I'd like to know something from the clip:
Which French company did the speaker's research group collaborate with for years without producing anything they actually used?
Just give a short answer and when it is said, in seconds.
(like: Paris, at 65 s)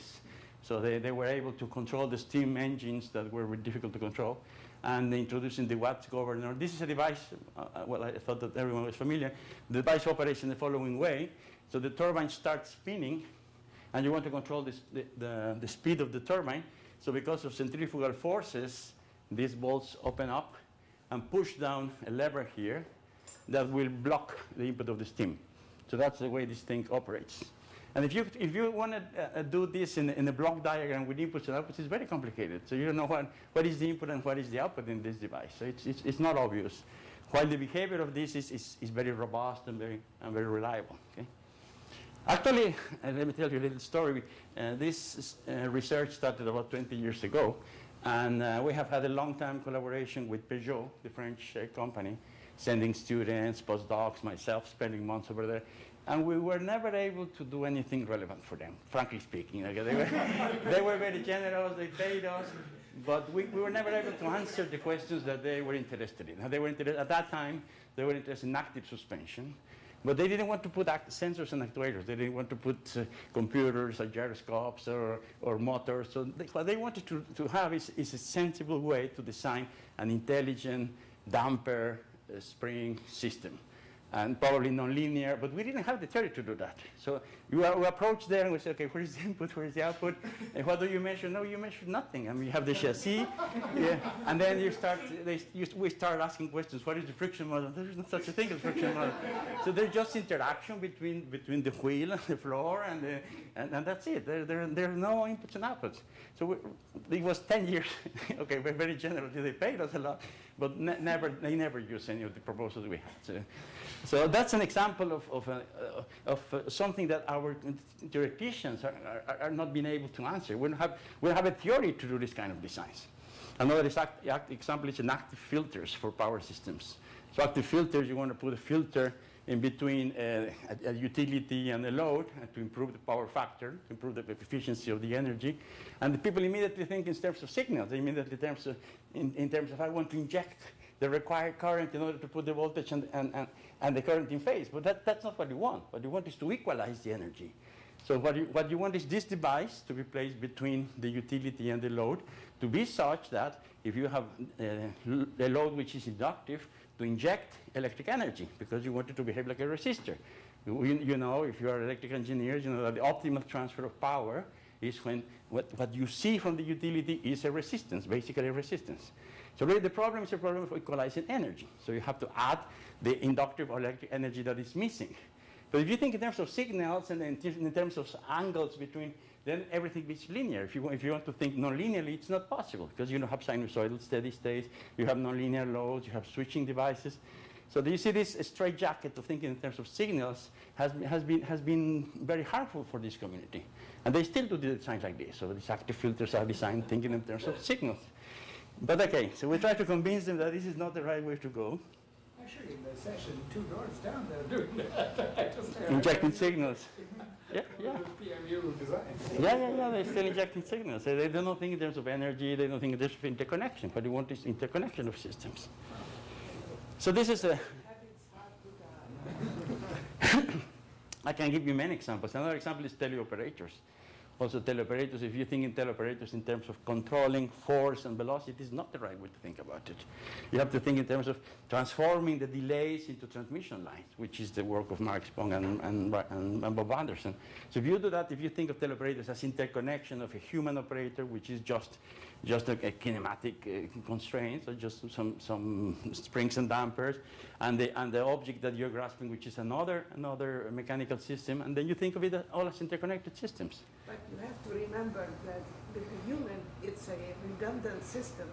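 Peugeot, at 50 s.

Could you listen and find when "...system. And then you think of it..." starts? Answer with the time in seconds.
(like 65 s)
251 s.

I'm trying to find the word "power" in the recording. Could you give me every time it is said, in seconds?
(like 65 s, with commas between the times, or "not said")
126 s, 132 s, 164 s.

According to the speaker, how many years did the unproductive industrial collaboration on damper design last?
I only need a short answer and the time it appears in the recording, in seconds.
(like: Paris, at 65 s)
10 years, at 107 s.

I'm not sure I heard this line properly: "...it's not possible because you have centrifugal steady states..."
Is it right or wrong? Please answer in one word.
wrong.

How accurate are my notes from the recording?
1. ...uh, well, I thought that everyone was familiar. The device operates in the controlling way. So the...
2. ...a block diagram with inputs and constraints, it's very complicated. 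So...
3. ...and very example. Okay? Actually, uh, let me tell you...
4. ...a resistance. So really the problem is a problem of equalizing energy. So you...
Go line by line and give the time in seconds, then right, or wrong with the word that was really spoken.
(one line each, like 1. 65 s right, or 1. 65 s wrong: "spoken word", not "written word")
1. 7 s wrong: "following", not "controlling"
2. 30 s wrong: "outputs", not "constraints"
3. 40 s wrong: "reliable", not "example"
4. 168 s right.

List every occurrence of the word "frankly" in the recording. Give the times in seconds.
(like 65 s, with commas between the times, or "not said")
58 s.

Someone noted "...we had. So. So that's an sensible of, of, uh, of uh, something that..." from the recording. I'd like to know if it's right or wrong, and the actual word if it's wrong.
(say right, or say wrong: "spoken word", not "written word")
wrong: "example", not "sensible".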